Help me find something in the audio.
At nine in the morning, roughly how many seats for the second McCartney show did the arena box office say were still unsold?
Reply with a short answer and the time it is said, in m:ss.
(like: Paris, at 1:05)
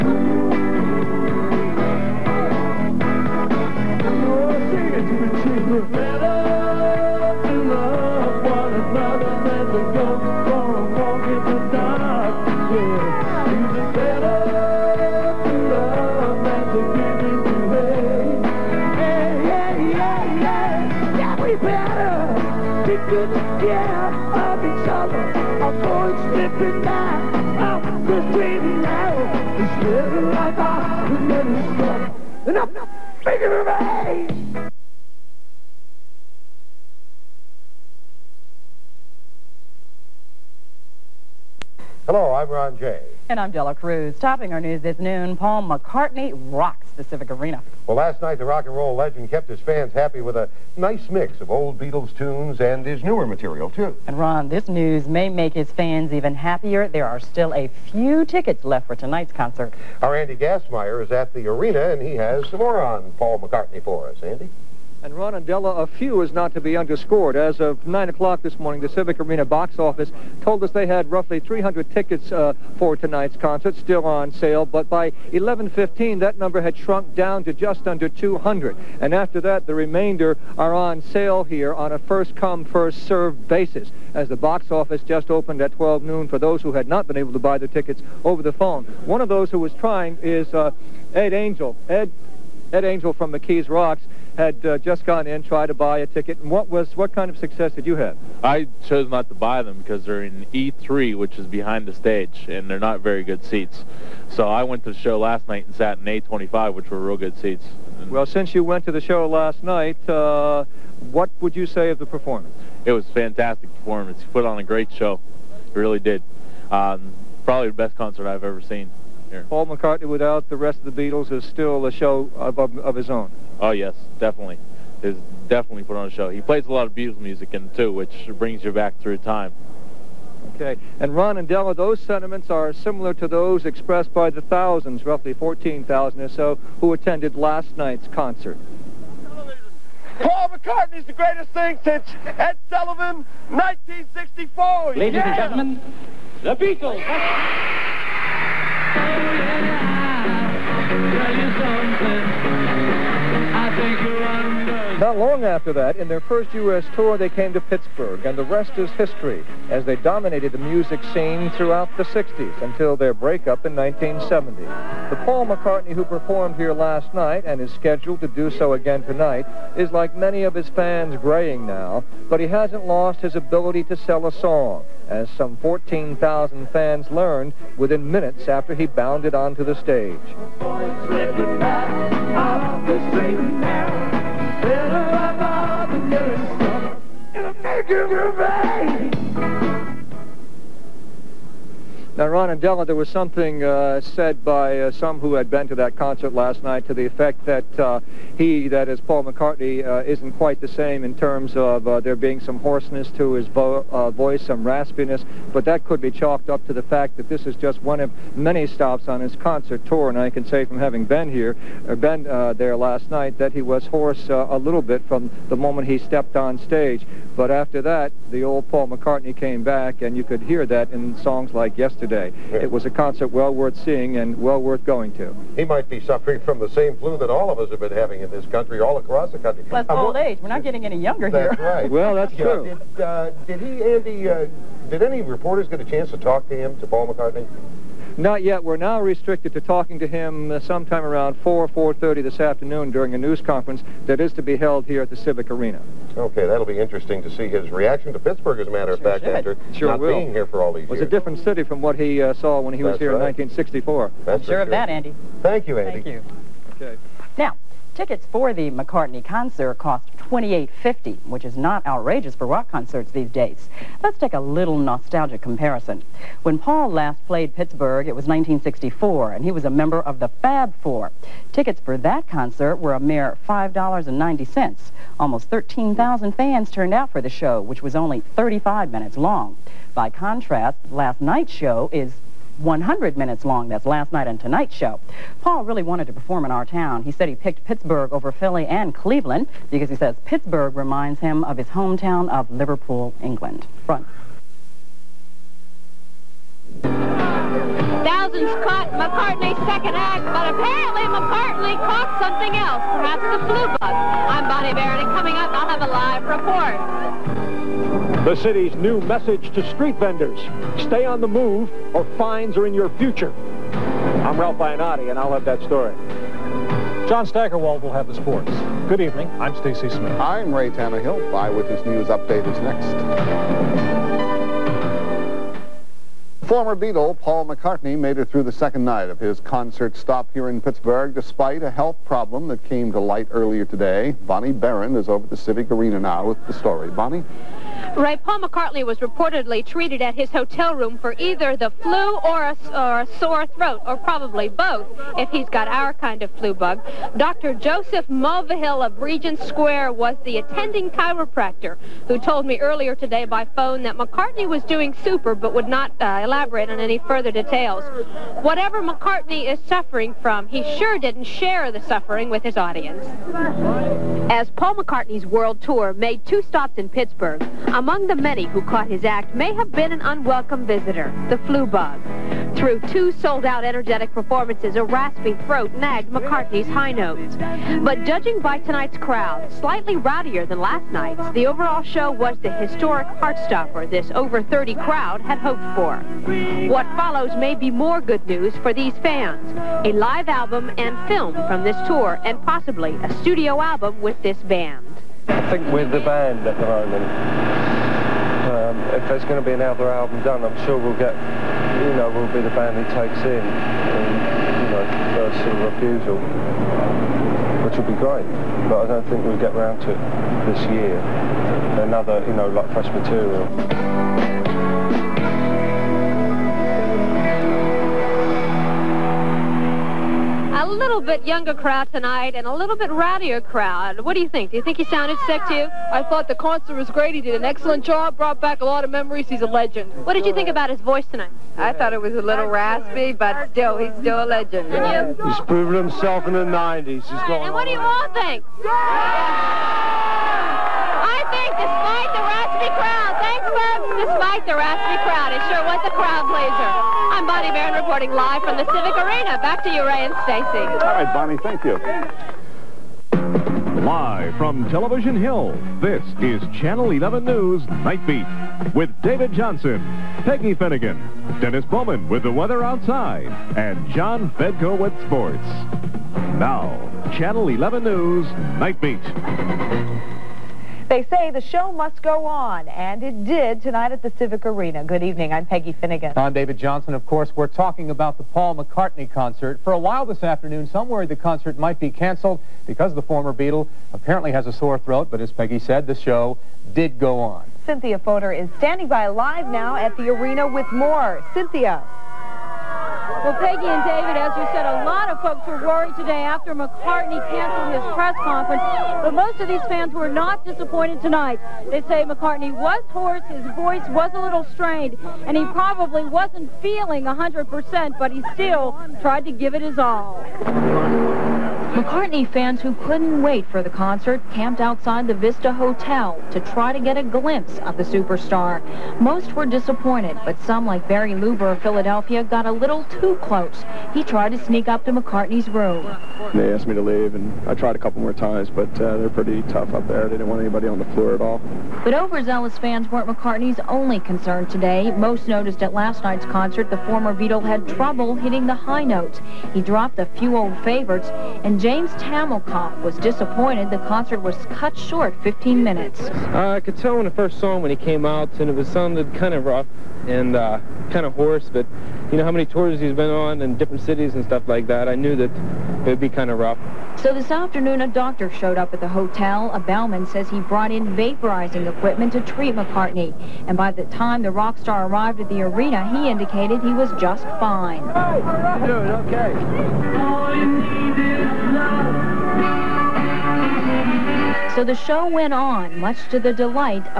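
300, at 1:11.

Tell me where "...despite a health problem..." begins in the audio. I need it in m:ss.
5:31.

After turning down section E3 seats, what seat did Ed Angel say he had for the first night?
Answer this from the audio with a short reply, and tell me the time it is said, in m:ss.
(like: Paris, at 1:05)
A25, at 1:46.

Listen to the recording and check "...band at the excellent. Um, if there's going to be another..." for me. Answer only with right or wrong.
wrong.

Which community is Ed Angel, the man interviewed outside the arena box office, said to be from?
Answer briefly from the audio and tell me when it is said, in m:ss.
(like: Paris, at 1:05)
McKees Rocks, at 1:33.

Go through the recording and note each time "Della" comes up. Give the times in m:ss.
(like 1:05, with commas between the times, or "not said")
0:43, 1:05, 2:11, 3:12.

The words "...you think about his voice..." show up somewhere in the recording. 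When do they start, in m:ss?
7:10.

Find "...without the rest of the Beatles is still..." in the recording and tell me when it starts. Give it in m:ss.
2:00.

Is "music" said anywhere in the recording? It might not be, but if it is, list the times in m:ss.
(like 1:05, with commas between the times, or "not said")
2:07, 2:40.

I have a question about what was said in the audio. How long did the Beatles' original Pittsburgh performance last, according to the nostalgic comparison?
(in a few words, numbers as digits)
35 minutes.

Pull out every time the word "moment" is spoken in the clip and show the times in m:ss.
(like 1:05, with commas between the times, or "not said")
3:35, 6:36.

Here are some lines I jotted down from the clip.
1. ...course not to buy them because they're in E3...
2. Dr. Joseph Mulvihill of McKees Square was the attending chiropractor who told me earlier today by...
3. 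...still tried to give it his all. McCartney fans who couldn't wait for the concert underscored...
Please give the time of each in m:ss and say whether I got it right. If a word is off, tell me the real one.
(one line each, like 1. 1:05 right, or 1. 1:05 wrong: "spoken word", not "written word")
1. 1:38 wrong: "chose", not "course"
2. 5:47 wrong: "Regent", not "McKees"
3. 8:28 wrong: "camped", not "underscored".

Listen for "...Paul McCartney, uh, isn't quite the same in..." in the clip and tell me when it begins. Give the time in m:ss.
3:19.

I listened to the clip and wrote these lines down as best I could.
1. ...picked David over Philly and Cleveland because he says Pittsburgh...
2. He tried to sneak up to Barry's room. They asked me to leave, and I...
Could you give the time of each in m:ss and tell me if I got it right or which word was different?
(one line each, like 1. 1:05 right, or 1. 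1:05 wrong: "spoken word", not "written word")
1. 4:47 wrong: "Pittsburgh", not "David"
2. 8:43 wrong: "McCartney", not "Barry".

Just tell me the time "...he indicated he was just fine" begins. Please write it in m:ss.
9:25.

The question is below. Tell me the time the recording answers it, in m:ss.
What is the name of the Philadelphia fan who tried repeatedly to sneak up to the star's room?
8:40.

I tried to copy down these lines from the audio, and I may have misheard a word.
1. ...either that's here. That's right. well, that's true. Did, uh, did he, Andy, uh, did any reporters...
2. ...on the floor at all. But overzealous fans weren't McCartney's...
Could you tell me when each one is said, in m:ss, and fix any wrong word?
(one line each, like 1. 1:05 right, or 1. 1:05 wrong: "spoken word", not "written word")
1. 3:50 wrong: "younger", not "either"
2. 8:50 right.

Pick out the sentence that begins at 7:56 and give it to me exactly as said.
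Of course, we're talking about the Paul McCartney concert.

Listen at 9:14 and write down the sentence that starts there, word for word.
I knew that it would be kind of rough.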